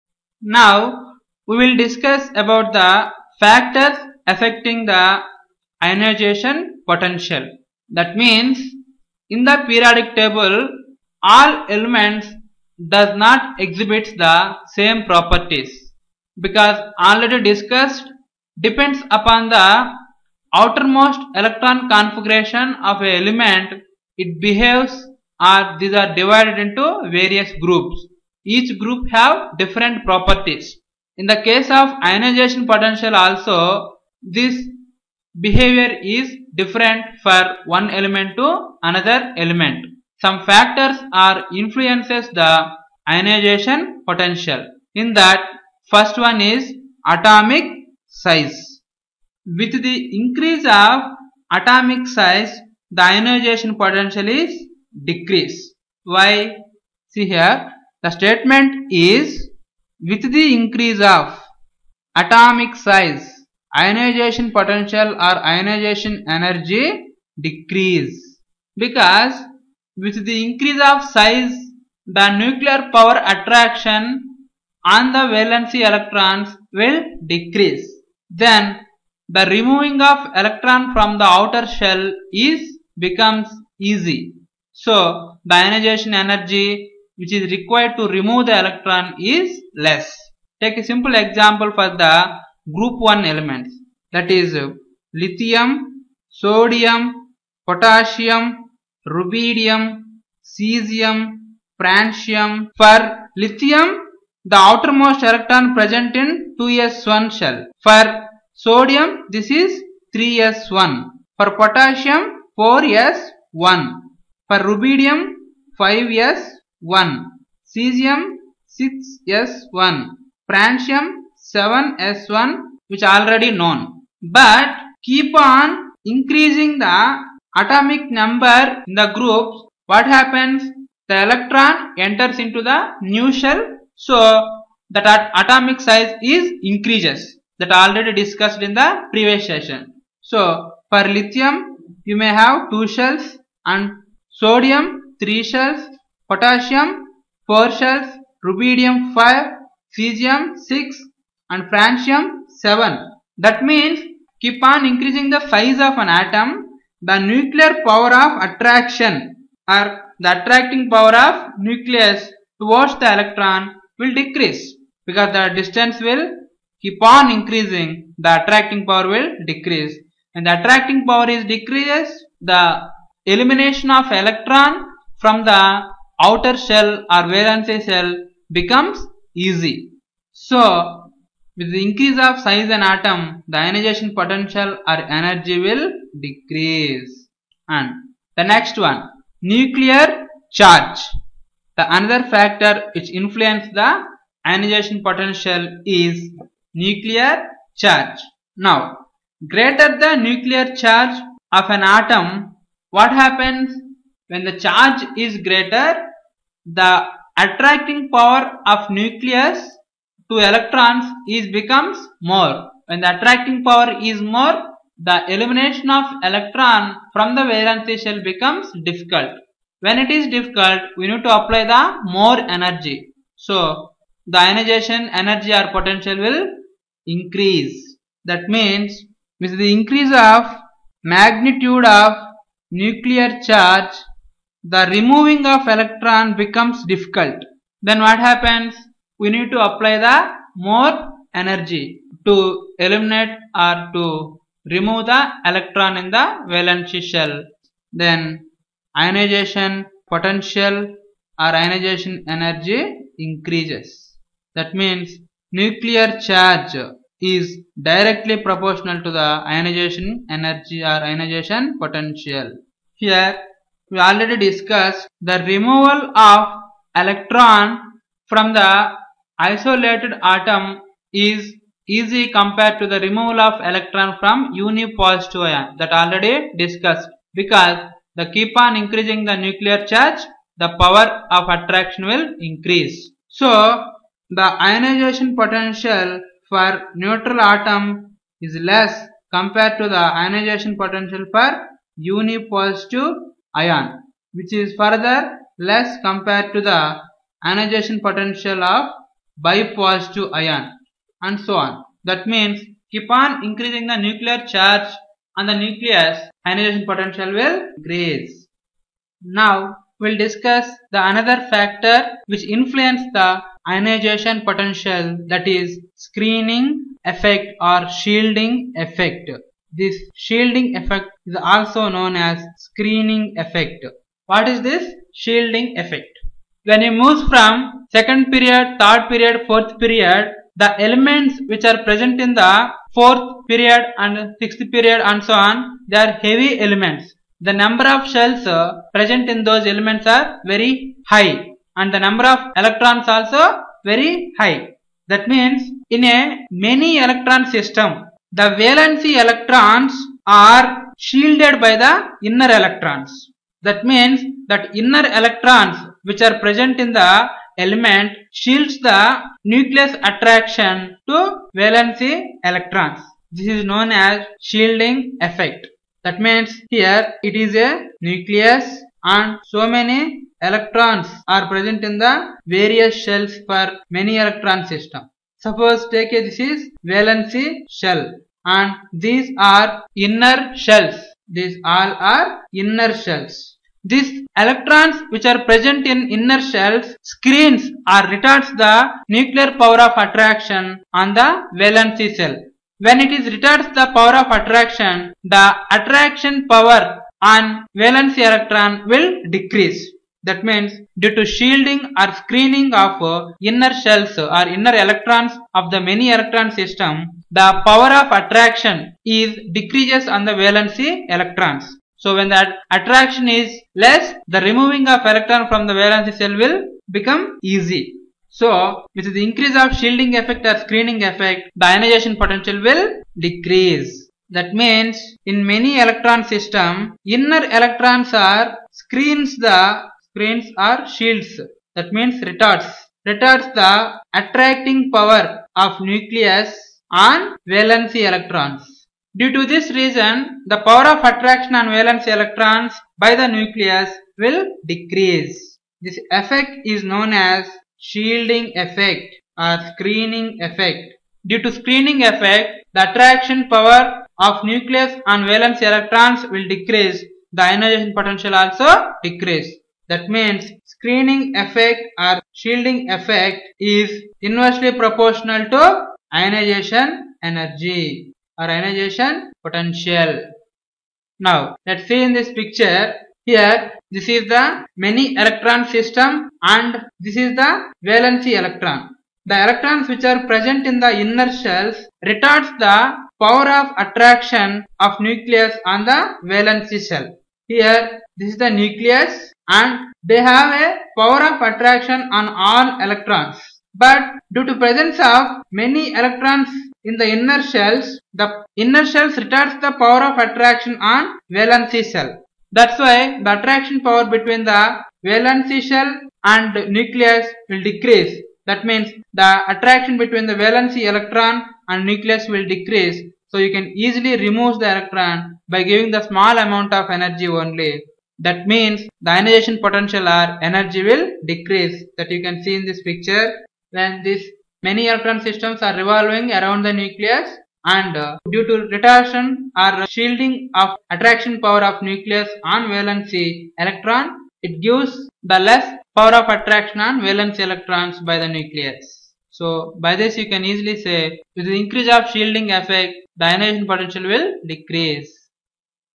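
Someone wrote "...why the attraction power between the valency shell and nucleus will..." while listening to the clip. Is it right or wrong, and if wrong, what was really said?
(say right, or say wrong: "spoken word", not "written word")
right.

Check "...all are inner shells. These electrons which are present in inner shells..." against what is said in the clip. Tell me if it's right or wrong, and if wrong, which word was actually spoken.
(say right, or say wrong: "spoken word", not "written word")
right.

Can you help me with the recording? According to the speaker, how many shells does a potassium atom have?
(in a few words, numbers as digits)
4.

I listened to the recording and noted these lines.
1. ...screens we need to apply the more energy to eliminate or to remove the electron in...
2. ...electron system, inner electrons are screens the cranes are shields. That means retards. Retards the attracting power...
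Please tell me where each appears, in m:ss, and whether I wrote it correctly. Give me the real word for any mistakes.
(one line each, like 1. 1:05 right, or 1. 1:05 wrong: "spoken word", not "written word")
1. 3:58 wrong: "happens", not "screens"
2. 7:05 right.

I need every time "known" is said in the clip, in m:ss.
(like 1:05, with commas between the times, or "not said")
2:03, 5:21, 6:03, 7:26.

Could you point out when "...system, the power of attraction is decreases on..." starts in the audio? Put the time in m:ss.
6:46.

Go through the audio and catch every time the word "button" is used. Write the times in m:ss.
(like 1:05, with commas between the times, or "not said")
not said.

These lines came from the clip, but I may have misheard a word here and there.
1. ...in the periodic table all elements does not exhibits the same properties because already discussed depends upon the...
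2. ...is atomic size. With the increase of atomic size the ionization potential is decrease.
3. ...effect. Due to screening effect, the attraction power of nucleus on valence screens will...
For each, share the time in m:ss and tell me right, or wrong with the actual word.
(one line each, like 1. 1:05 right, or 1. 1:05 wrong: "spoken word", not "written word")
1. 0:09 right
2. 0:46 right
3. 7:30 wrong: "electrons", not "screens".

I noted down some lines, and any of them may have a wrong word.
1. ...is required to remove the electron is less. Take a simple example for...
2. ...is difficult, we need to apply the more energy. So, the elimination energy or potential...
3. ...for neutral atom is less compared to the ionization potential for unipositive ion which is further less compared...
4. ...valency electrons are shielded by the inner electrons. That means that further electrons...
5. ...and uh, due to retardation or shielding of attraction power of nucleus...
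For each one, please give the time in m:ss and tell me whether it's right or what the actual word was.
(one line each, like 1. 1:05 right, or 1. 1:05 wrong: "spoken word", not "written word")
1. 1:27 right
2. 3:40 wrong: "ionization", not "elimination"
3. 4:46 right
4. 5:48 wrong: "inner", not "further"
5. 8:47 right.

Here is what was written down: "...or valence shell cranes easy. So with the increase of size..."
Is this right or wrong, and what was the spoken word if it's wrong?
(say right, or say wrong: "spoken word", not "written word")
wrong: "becomes", not "cranes".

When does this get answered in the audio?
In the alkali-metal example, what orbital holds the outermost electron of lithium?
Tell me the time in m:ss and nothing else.
1:46.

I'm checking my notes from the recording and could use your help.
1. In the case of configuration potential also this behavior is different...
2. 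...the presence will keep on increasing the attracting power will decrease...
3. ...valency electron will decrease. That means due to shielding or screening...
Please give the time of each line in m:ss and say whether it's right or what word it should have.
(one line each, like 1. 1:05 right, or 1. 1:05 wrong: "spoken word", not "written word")
1. 0:31 wrong: "ionization", not "configuration"
2. 2:45 wrong: "distance", not "presence"
3. 6:37 right.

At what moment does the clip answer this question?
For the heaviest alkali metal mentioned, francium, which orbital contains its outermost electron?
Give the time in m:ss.
2:00.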